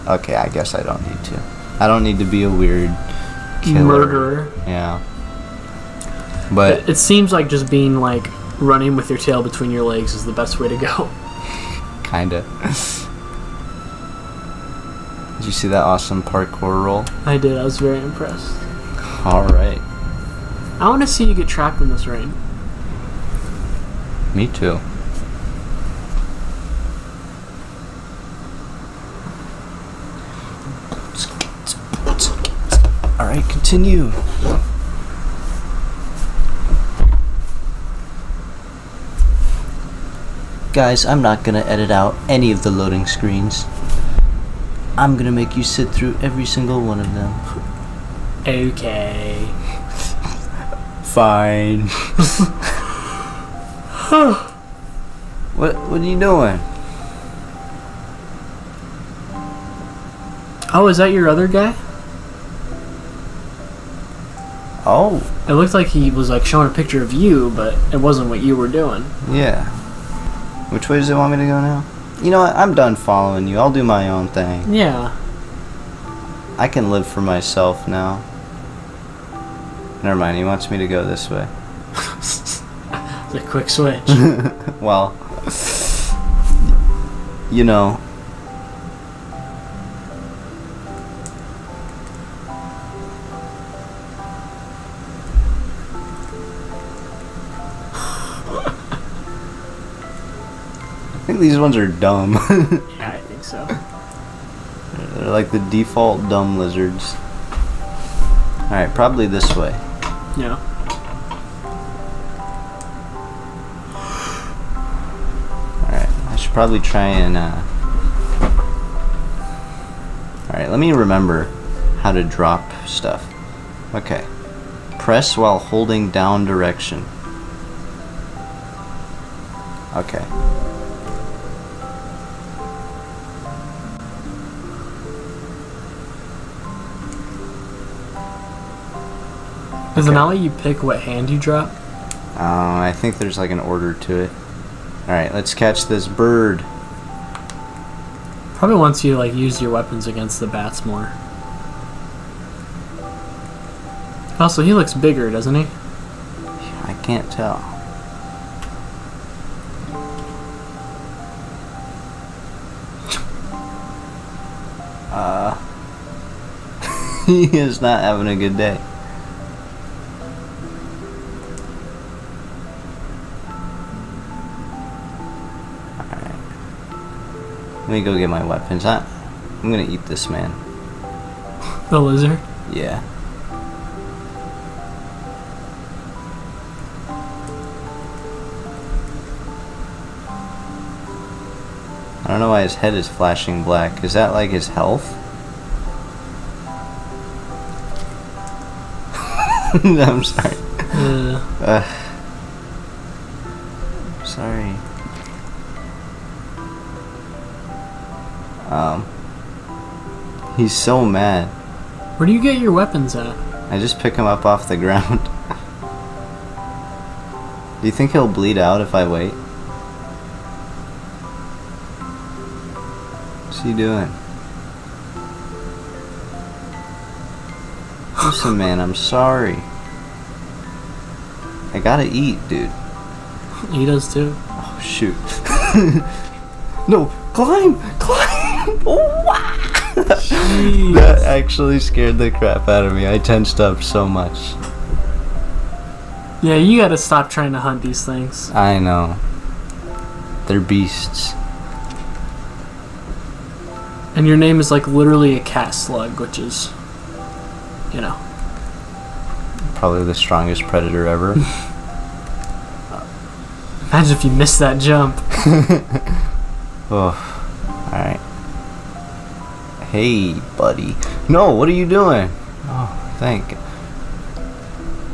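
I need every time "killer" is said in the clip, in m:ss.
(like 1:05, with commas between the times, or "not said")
0:03.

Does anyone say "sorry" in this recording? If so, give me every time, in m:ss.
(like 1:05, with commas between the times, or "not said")
3:20, 3:48.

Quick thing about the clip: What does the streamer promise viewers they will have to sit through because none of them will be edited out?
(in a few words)
Loading screens.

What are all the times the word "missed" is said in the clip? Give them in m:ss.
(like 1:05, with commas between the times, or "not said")
4:24.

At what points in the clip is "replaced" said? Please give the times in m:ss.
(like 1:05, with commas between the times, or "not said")
not said.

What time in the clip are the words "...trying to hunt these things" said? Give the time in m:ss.
4:07.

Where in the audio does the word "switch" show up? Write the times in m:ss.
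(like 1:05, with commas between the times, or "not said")
1:23.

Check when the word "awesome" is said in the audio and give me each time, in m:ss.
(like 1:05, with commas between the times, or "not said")
0:15.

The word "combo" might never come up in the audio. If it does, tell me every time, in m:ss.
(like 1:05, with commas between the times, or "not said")
not said.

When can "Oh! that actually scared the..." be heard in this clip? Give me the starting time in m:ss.
3:58.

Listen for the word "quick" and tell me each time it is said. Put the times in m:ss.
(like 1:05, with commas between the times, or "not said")
1:23.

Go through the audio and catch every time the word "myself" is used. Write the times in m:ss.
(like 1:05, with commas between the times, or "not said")
1:17.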